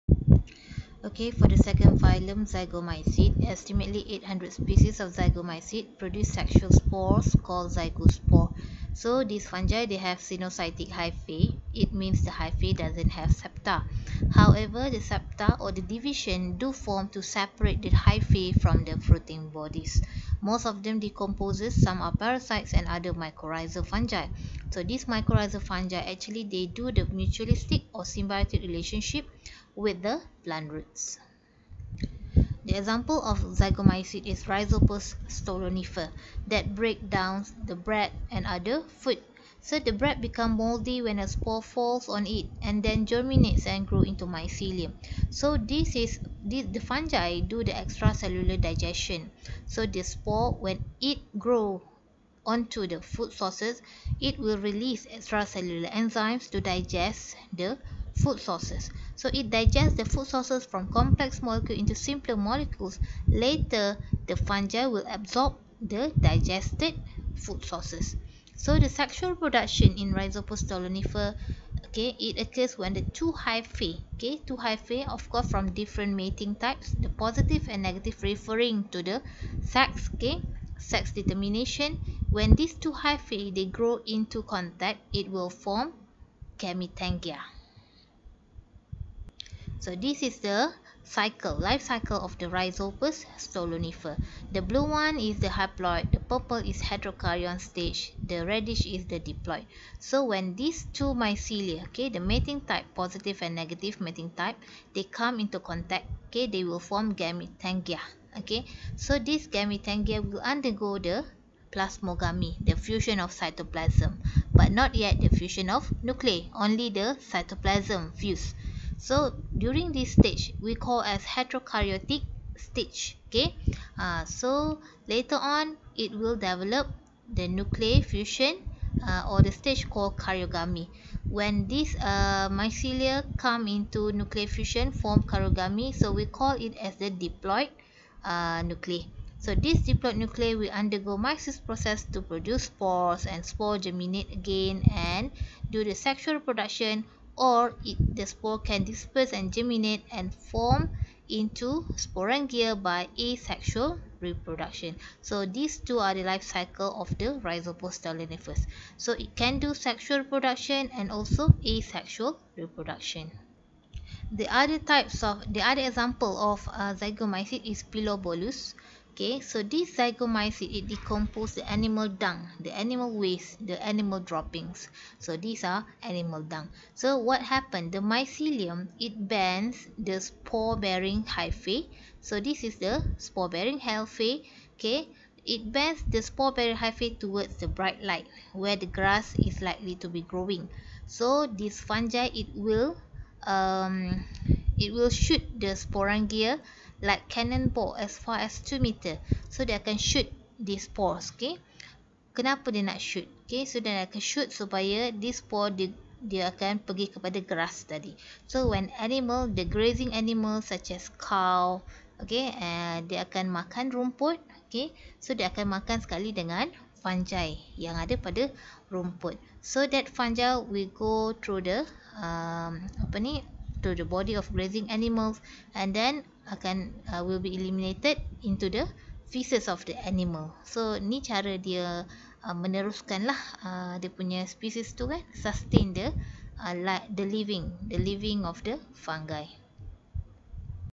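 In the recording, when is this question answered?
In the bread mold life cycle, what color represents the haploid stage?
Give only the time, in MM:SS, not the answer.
01:34.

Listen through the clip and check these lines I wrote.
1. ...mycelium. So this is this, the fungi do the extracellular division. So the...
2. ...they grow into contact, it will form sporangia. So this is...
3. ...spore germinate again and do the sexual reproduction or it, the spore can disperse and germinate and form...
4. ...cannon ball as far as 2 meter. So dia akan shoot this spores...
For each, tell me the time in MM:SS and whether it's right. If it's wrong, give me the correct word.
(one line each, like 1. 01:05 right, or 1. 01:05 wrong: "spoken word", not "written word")
1. 00:44 wrong: "digestion", not "division"
2. 01:23 wrong: "gametangia", not "sporangia"
3. 02:23 right
4. 03:17 right.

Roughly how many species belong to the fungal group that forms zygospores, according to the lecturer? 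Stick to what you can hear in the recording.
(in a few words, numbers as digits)
800.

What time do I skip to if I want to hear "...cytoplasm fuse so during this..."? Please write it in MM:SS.
01:57.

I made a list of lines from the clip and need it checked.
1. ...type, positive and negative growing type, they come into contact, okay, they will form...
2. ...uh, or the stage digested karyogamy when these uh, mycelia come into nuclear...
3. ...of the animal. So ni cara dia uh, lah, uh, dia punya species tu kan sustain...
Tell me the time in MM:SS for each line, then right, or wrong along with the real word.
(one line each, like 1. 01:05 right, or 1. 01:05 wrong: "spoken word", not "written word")
1. 01:42 wrong: "mating", not "growing"
2. 02:09 wrong: "called", not "digested"
3. 03:49 right.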